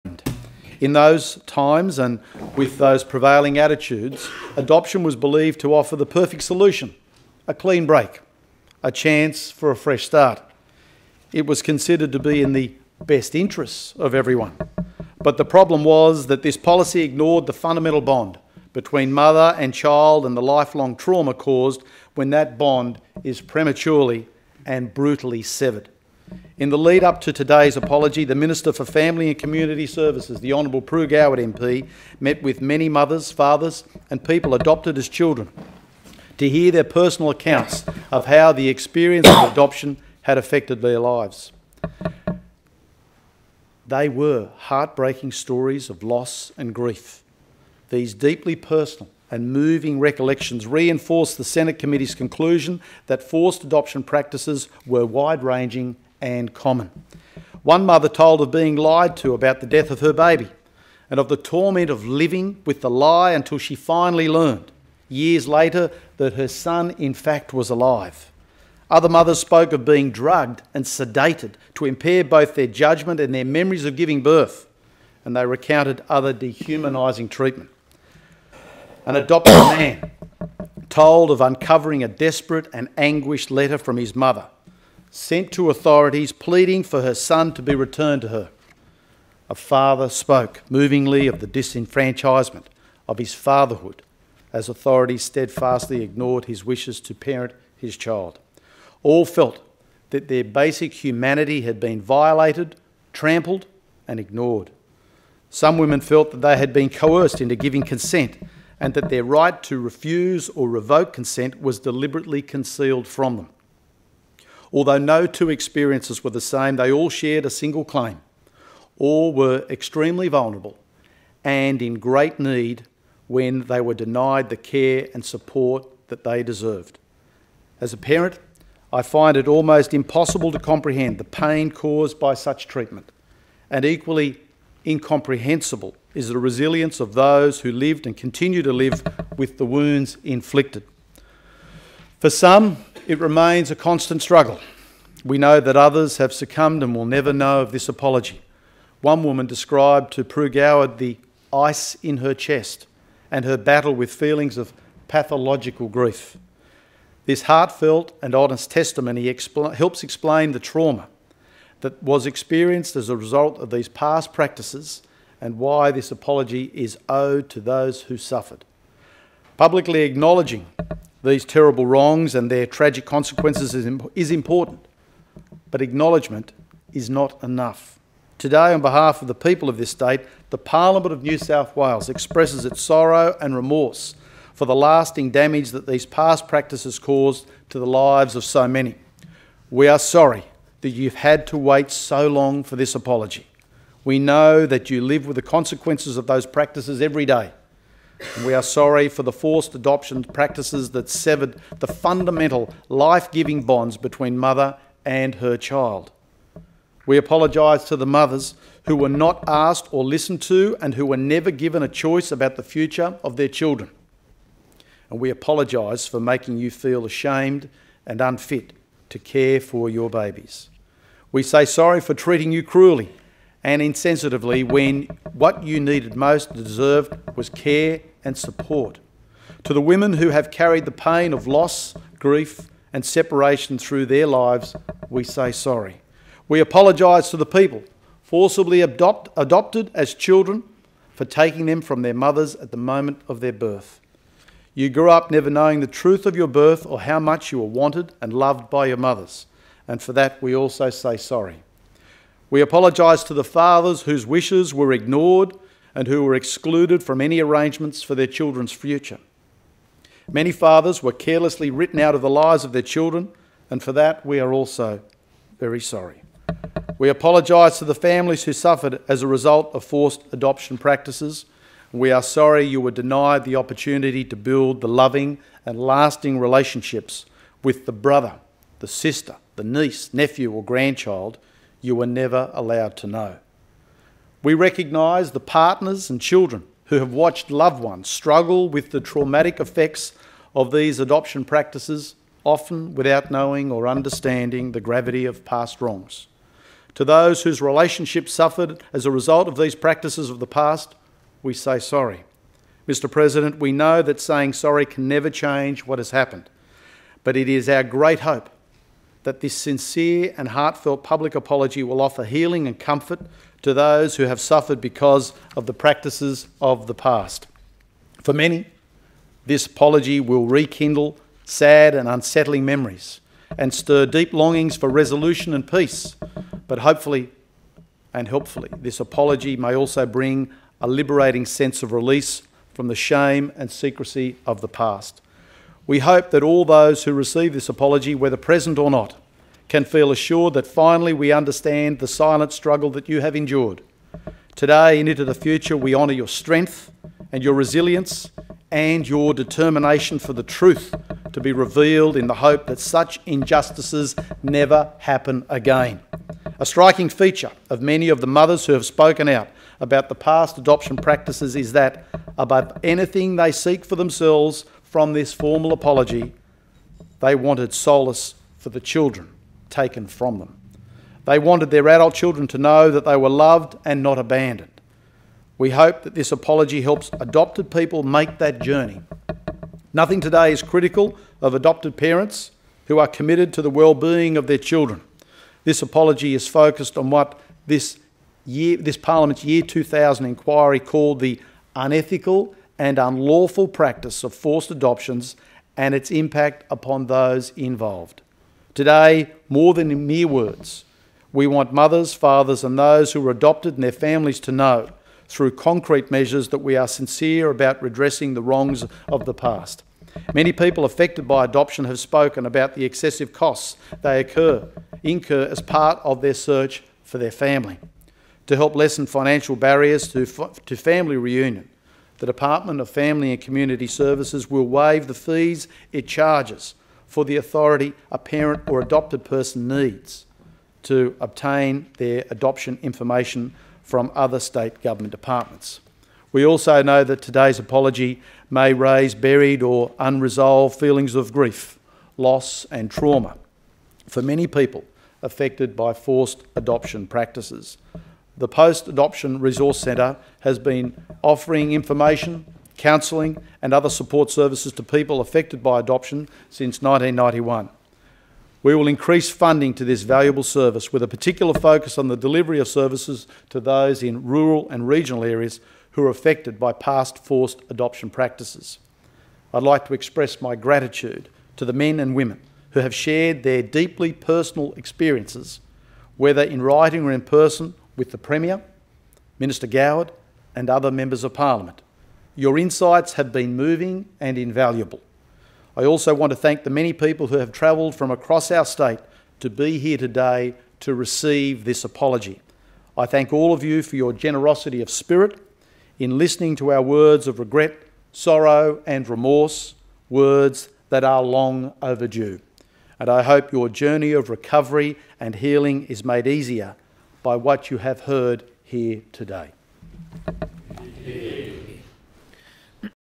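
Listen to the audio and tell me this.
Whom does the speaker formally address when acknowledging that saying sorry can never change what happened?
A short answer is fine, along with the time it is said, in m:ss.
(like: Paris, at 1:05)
Mr. President, at 5:02.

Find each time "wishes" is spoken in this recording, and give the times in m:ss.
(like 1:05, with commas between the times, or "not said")
1:36, 4:14.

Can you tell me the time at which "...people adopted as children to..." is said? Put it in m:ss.
0:34.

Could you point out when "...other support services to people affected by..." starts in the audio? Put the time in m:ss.
7:33.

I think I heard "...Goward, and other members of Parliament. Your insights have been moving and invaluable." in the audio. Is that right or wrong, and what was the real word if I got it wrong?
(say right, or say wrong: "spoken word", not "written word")
right.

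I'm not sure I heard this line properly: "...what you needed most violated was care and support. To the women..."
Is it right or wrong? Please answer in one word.
wrong.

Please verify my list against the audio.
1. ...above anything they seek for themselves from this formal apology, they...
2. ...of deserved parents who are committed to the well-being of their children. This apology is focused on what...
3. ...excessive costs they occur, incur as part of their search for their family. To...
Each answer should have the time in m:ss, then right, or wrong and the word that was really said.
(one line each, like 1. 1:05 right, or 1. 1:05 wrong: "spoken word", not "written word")
1. 6:02 right
2. 6:21 wrong: "adopted", not "deserved"
3. 6:52 right.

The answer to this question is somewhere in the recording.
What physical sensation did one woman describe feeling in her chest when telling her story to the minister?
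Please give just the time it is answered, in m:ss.
2:31.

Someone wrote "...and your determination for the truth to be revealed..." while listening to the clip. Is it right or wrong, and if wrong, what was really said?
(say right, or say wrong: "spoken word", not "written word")
right.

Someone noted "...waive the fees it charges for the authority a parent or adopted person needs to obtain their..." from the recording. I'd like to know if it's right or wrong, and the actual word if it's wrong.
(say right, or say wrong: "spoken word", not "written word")
right.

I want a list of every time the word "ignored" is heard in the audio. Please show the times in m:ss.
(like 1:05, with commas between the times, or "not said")
0:17, 1:36, 1:44, 4:14.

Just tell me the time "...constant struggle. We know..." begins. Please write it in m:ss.
2:23.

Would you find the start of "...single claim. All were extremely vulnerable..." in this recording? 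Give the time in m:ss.
1:57.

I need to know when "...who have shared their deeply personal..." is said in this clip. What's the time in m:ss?
7:52.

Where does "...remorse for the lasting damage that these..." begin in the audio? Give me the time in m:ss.
3:03.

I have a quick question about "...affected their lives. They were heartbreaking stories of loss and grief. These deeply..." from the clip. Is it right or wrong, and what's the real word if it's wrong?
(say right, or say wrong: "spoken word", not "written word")
right.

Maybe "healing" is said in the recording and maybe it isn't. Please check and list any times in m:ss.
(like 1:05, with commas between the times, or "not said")
5:12, 8:25.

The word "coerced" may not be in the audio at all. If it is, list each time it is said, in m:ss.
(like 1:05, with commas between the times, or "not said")
1:46.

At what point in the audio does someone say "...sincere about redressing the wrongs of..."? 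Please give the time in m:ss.
6:46.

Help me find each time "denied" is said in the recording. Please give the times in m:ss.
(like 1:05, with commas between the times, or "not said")
2:03, 4:32.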